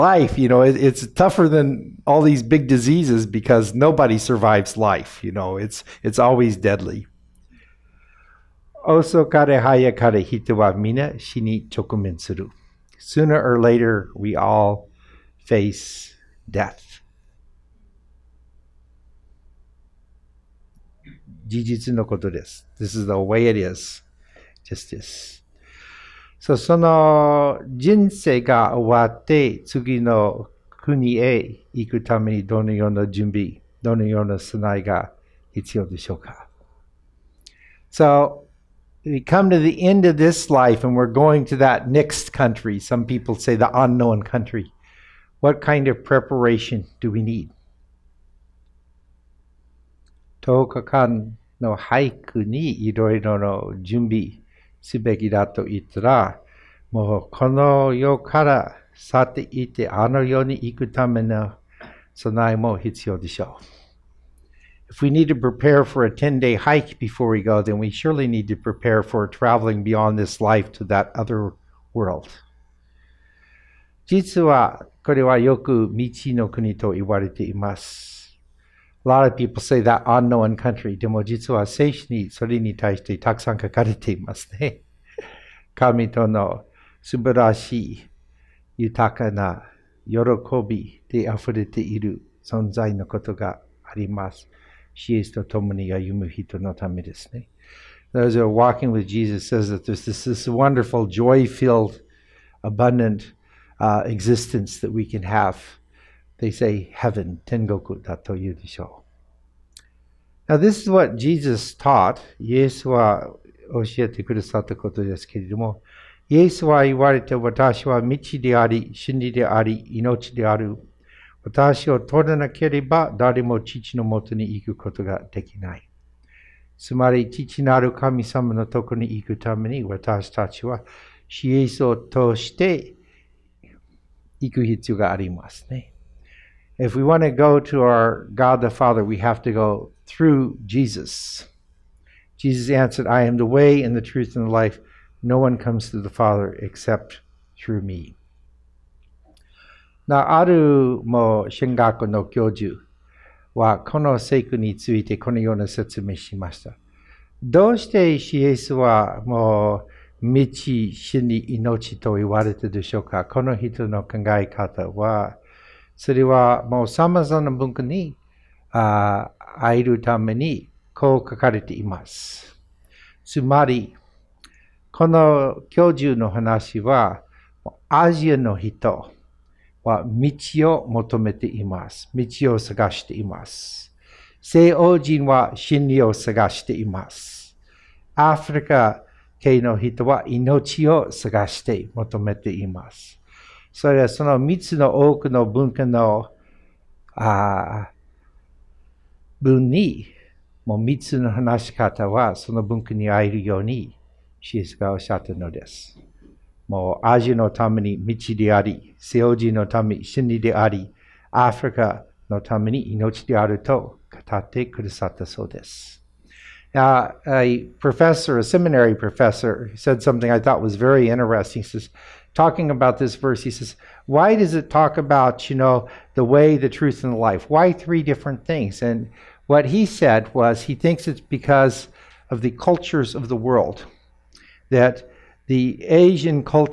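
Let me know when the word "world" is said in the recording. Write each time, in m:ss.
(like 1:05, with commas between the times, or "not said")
1:11, 3:53.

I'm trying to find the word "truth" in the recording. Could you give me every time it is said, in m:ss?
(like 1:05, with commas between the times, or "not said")
2:24, 3:46.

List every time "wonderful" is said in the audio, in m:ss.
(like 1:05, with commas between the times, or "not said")
1:40.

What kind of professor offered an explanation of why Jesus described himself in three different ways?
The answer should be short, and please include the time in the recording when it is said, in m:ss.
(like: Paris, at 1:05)
A seminary professor, at 3:38.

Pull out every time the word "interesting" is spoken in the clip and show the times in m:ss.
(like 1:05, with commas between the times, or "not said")
3:41.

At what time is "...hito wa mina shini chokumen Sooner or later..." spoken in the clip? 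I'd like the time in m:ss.
0:10.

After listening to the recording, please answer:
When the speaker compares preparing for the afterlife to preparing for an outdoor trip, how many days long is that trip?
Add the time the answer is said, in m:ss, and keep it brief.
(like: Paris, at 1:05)
10, at 1:06.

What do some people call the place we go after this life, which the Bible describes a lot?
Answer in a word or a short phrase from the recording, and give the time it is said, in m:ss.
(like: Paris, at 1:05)
the unknown country, at 0:43.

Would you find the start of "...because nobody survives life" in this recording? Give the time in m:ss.
0:03.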